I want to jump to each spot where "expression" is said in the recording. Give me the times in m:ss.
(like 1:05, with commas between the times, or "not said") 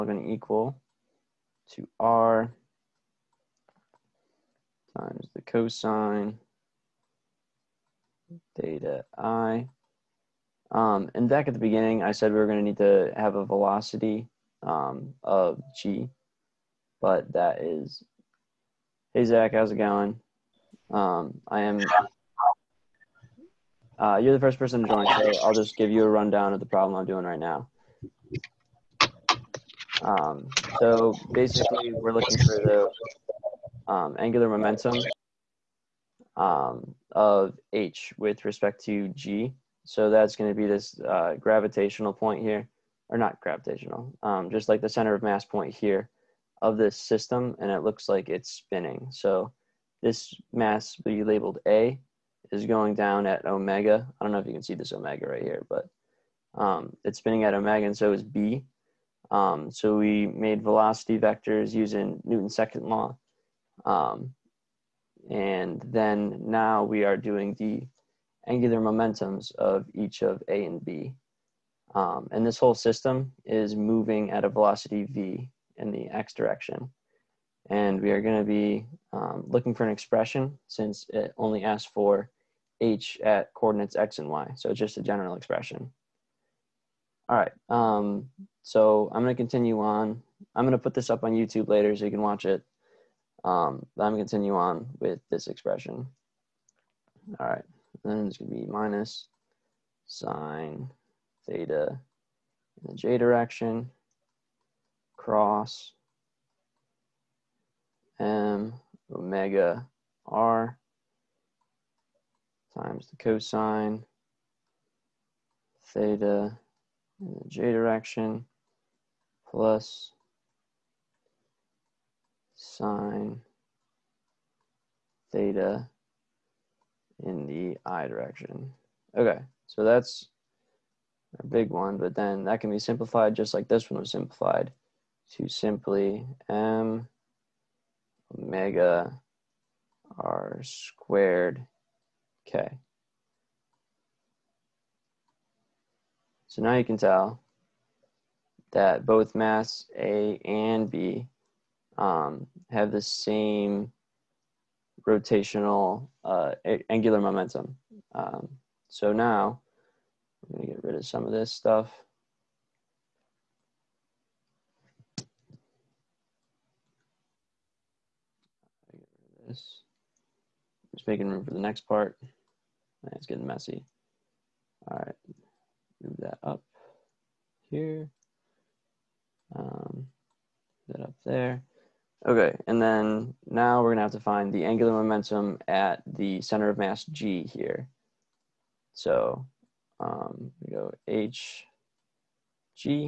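1:19, 1:25, 1:35.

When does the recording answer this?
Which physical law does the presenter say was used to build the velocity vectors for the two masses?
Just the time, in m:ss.
1:02.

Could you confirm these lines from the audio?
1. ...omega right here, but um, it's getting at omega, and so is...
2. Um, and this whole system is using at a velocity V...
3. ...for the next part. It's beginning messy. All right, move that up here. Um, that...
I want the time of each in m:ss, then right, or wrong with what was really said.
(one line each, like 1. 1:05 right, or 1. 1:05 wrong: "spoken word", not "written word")
1. 0:54 wrong: "spinning", not "getting"
2. 1:11 wrong: "moving", not "using"
3. 2:51 wrong: "getting", not "beginning".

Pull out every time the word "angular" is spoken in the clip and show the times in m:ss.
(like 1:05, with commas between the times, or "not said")
0:34, 1:08, 2:36, 3:04.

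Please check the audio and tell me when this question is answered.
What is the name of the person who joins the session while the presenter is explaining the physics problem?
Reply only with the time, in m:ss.
0:19.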